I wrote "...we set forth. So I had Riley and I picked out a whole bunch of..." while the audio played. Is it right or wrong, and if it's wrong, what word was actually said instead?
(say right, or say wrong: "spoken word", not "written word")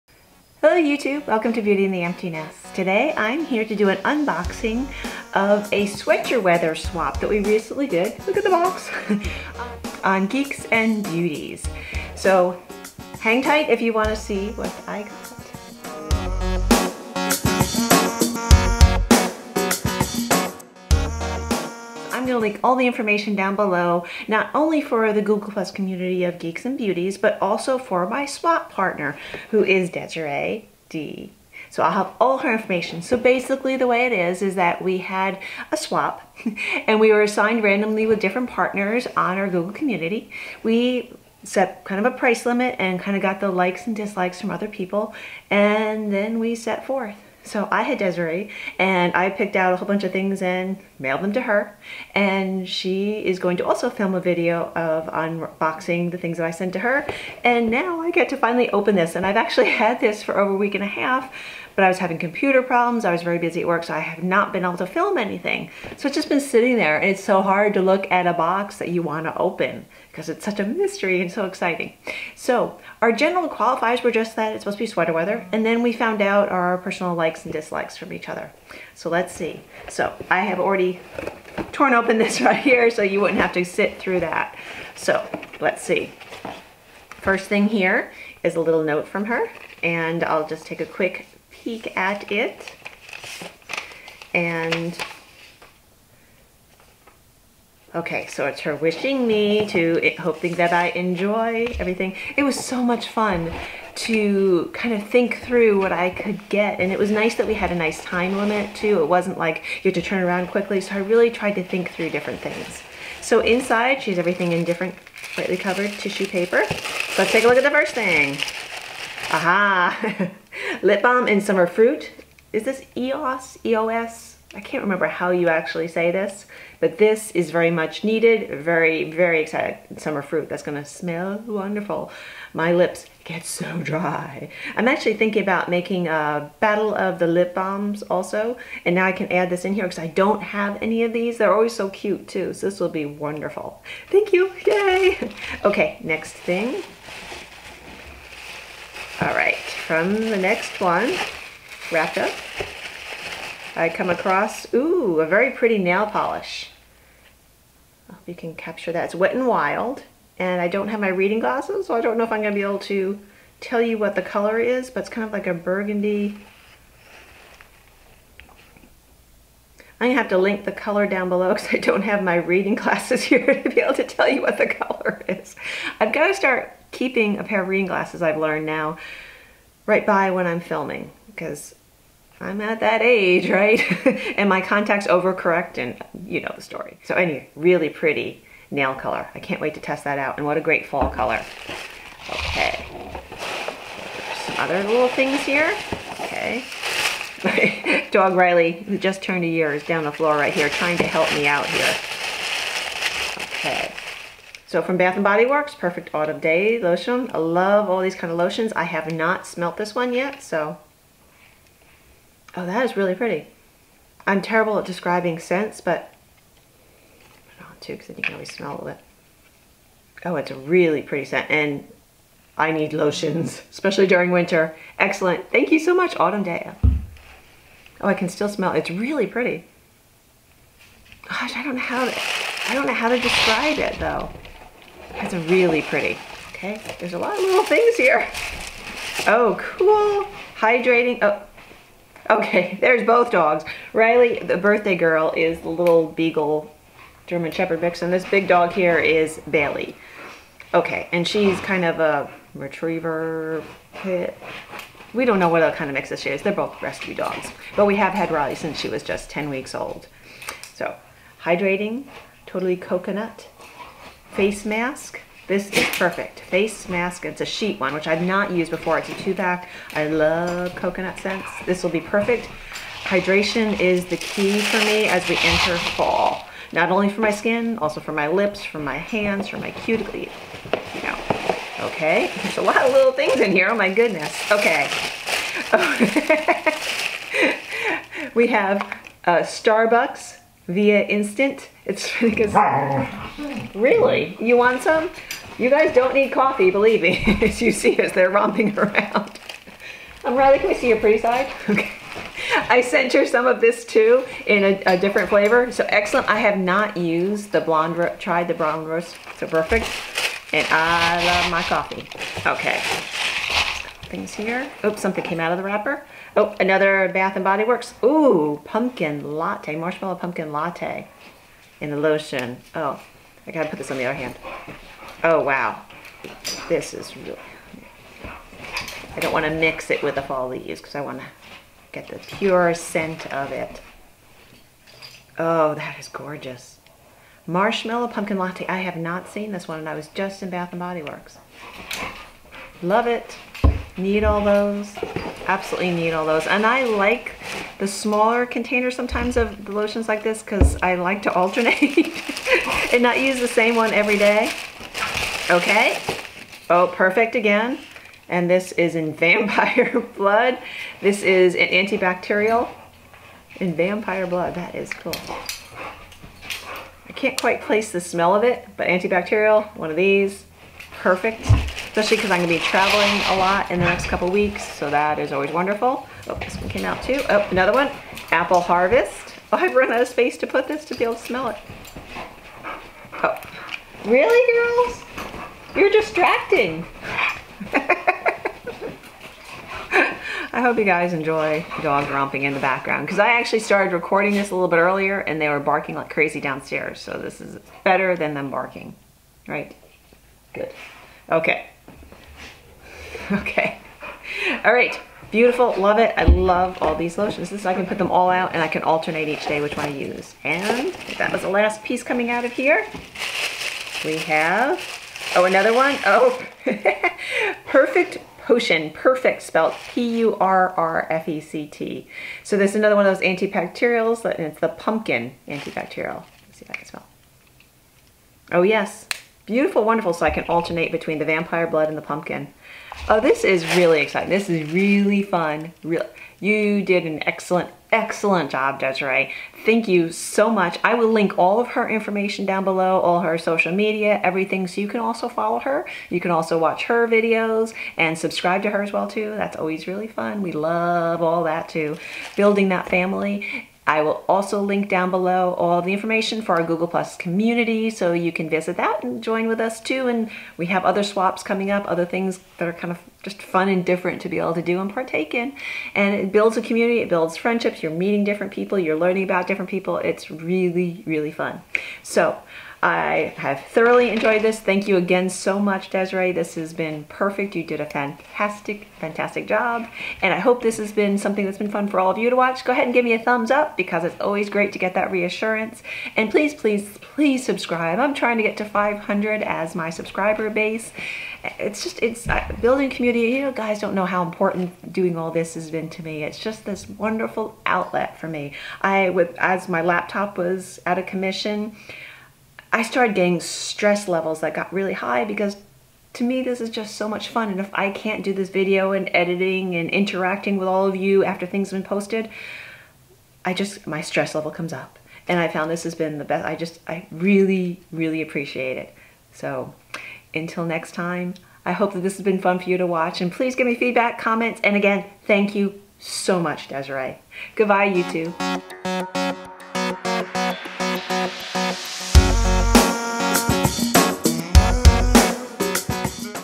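wrong: "Desiree", not "Riley".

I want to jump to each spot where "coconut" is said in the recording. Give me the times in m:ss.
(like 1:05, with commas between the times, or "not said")
4:22, 4:30.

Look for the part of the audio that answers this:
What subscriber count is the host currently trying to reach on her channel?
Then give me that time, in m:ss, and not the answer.
8:08.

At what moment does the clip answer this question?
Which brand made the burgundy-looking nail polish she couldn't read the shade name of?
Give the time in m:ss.
2:39.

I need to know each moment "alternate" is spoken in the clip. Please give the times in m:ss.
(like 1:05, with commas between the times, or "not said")
5:51, 6:48, 7:10.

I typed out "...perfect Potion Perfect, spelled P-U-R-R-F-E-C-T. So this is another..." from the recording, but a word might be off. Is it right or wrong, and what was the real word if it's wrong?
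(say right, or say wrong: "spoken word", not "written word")
right.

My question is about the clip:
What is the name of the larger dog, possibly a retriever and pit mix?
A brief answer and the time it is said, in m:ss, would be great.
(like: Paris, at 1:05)
Bailey, at 4:09.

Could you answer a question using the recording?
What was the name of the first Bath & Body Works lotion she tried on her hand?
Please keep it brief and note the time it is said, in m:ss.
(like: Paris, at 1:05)
Perfect Autumn Day, at 3:25.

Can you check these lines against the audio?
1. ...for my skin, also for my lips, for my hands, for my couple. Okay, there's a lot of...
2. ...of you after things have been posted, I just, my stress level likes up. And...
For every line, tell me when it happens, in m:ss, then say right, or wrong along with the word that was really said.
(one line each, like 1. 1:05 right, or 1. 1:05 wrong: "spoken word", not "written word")
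1. 4:37 wrong: "cuticle", not "couple"
2. 8:30 wrong: "comes", not "likes".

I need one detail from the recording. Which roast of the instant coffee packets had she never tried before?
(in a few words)
Blonde roast.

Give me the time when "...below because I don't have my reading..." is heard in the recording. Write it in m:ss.
2:51.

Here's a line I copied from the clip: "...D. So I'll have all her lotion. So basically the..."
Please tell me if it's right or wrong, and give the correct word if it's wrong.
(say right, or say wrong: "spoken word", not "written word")
wrong: "information", not "lotion".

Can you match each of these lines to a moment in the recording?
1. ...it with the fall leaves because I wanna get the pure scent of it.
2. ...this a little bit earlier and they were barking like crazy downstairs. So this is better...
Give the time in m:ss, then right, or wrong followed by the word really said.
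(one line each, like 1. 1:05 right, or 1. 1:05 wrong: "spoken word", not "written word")
1. 5:29 right
2. 6:34 right.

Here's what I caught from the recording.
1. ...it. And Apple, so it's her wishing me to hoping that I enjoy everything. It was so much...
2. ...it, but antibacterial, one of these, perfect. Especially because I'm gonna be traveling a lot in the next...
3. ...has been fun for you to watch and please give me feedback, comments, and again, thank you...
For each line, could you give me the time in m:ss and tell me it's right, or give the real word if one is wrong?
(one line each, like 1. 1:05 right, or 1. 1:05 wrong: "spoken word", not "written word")
1. 1:32 wrong: "Okay", not "Apple"
2. 6:08 right
3. 8:42 right.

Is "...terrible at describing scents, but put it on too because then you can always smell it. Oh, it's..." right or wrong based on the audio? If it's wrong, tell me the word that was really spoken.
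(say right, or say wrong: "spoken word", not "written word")
right.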